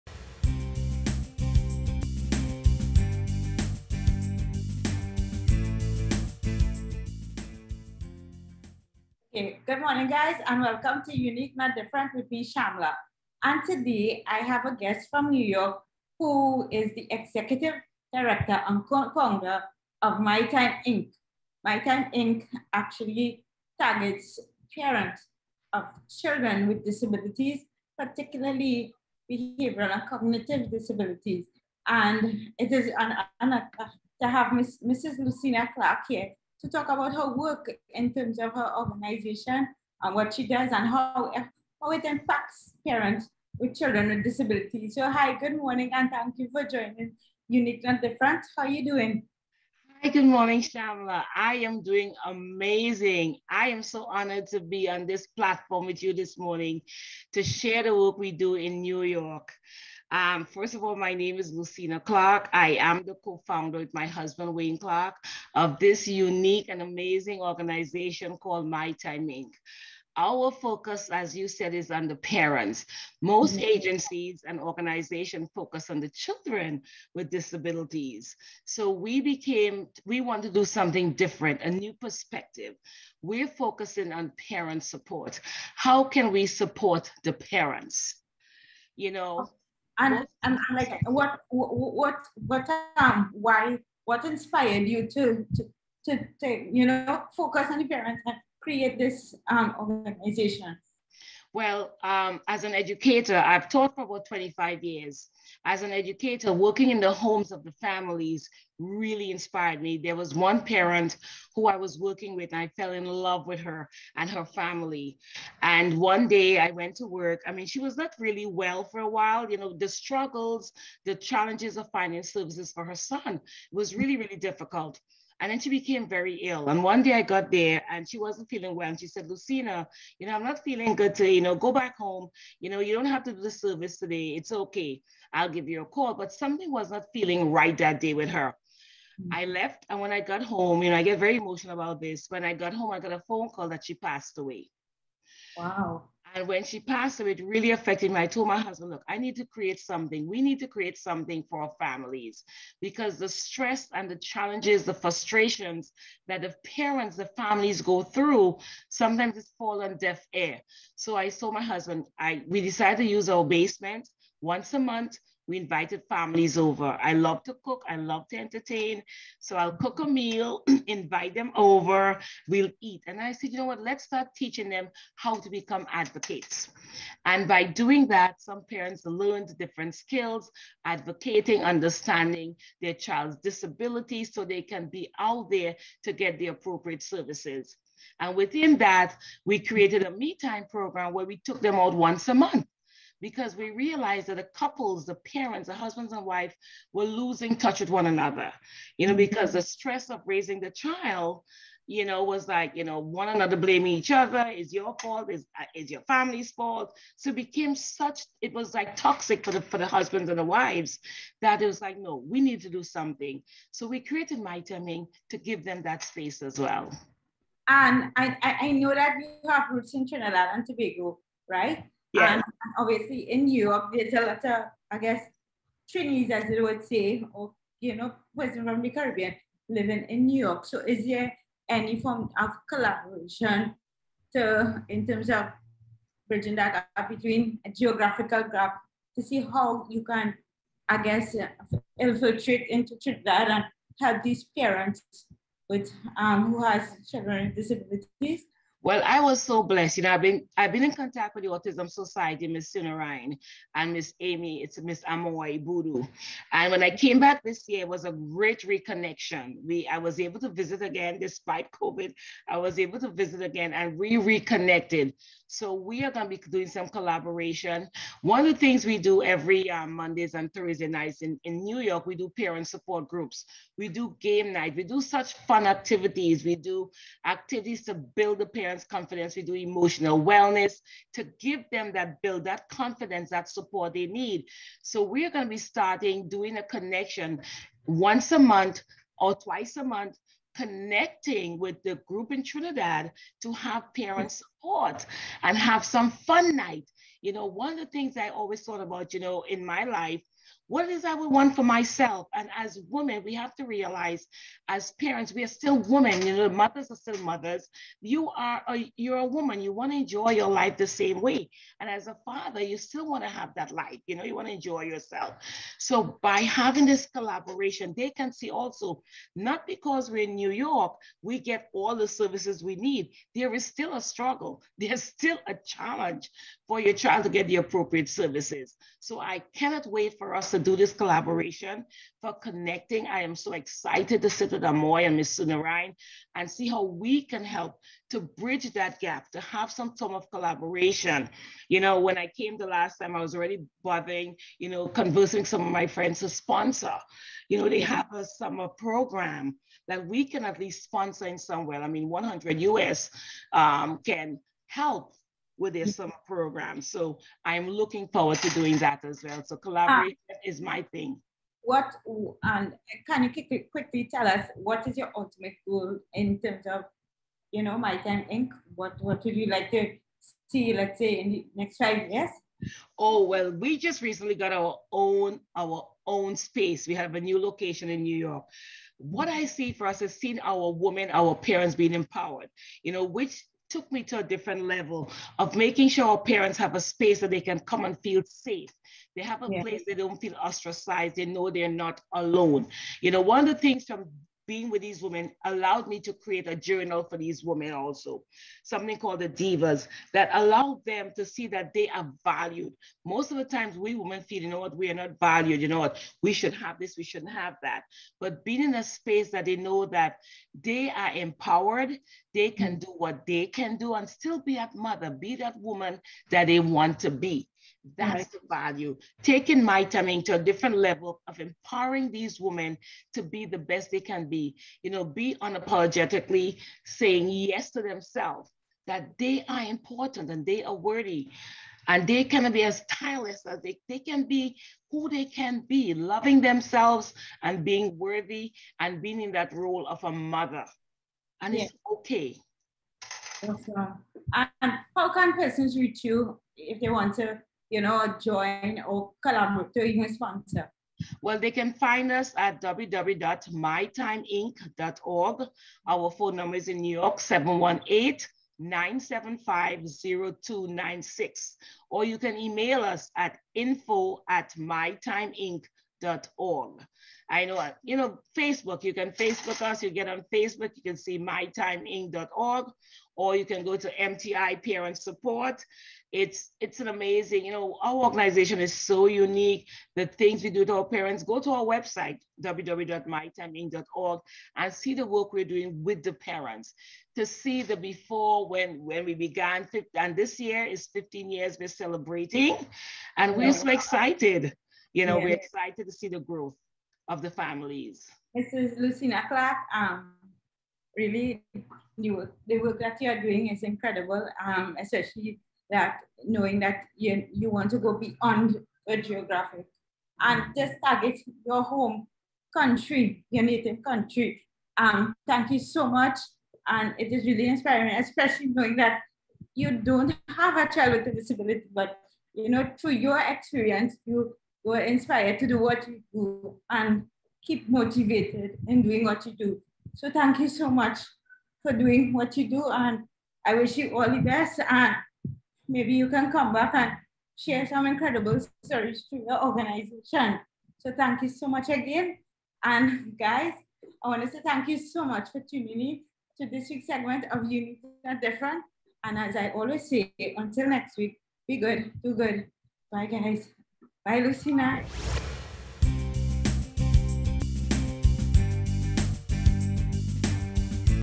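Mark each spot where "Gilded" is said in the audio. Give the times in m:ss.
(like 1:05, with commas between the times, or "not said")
not said.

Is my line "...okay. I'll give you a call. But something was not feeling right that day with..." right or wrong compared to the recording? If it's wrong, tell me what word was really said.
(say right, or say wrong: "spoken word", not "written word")
right.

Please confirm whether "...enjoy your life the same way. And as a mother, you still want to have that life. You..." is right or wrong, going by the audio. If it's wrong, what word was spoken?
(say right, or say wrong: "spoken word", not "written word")
wrong: "father", not "mother".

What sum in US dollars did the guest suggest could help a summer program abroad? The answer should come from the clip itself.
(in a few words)
100.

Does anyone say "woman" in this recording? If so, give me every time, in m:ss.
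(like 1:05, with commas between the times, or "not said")
5:09, 6:55.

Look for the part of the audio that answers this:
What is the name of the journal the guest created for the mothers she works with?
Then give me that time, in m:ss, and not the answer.
6:39.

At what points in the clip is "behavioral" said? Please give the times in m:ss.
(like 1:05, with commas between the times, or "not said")
0:29.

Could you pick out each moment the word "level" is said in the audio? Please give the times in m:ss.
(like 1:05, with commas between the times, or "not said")
6:24, 7:00.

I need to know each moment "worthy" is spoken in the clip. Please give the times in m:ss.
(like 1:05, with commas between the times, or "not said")
7:10, 7:17.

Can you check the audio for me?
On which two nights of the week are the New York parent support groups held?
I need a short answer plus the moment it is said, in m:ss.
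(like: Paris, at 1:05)
Mondays and Thursday, at 4:29.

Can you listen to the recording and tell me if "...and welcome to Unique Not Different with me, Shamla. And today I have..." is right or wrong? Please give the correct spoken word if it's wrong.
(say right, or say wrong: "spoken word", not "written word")
right.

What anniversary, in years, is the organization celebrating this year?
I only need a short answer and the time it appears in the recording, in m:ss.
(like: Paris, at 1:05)
15, at 8:10.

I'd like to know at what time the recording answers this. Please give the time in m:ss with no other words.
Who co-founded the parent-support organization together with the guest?
1:04.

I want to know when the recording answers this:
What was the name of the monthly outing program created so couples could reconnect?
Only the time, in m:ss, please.
3:10.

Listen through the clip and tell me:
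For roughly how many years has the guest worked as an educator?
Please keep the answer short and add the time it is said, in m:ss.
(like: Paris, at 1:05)
25 years, at 1:44.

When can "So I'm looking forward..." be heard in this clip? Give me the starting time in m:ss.
5:56.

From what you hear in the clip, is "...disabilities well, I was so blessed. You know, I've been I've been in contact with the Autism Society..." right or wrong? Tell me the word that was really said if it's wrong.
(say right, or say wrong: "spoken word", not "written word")
right.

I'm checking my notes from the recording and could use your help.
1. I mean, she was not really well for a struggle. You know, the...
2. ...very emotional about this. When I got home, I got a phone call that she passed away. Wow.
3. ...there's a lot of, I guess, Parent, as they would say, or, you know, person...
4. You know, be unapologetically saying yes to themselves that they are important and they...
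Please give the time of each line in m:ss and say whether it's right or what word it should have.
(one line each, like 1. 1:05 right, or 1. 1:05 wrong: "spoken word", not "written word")
1. 1:57 wrong: "while", not "struggle"
2. 2:21 right
3. 3:43 wrong: "Chinese", not "Parent"
4. 7:04 right.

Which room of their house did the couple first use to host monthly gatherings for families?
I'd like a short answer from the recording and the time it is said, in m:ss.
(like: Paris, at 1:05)
basement, at 2:43.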